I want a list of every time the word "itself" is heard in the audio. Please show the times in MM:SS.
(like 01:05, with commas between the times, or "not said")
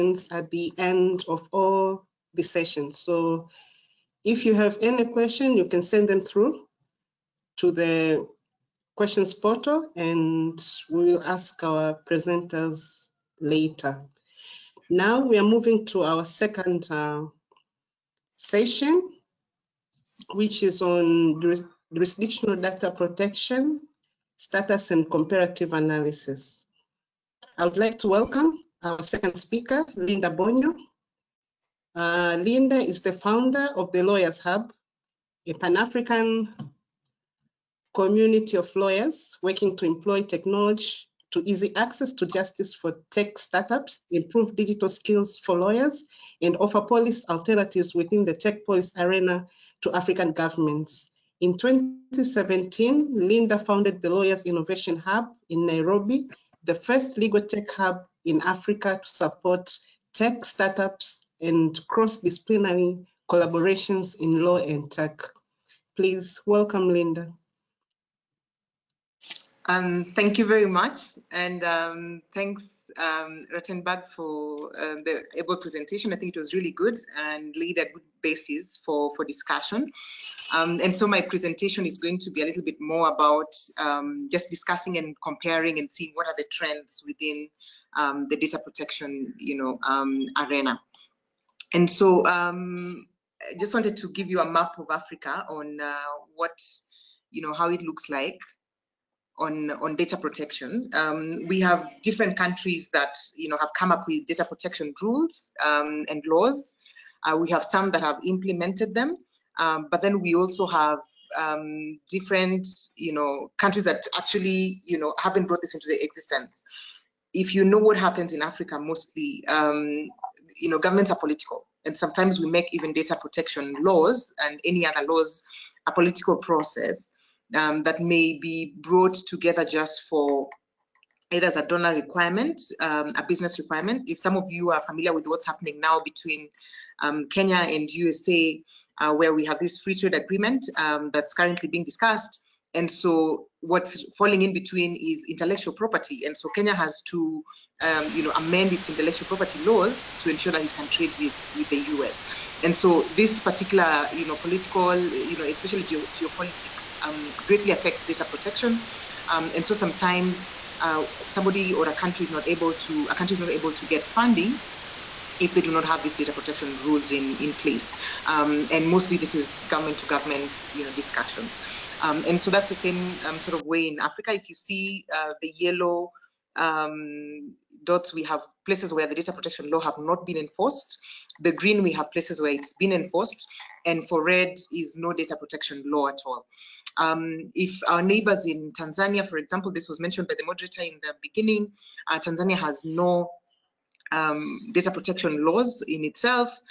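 03:16.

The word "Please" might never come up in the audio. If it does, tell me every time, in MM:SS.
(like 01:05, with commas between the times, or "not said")
01:05.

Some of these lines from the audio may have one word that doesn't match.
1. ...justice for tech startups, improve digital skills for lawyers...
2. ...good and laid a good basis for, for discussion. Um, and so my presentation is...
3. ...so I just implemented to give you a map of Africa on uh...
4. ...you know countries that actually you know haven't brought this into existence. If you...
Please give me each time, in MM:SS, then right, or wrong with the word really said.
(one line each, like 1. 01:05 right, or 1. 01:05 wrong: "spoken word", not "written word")
1. 00:42 right
2. 01:16 right
3. 01:31 wrong: "wanted", not "implemented"
4. 01:52 right.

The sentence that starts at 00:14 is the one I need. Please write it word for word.
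Now we are moving to our second uh, session, which is on jurisdictional data protection, status and comparative analysis.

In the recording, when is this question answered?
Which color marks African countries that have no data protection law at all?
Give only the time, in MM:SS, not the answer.
03:04.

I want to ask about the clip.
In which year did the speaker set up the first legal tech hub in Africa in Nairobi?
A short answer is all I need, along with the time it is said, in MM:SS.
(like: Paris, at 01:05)
2017, at 00:51.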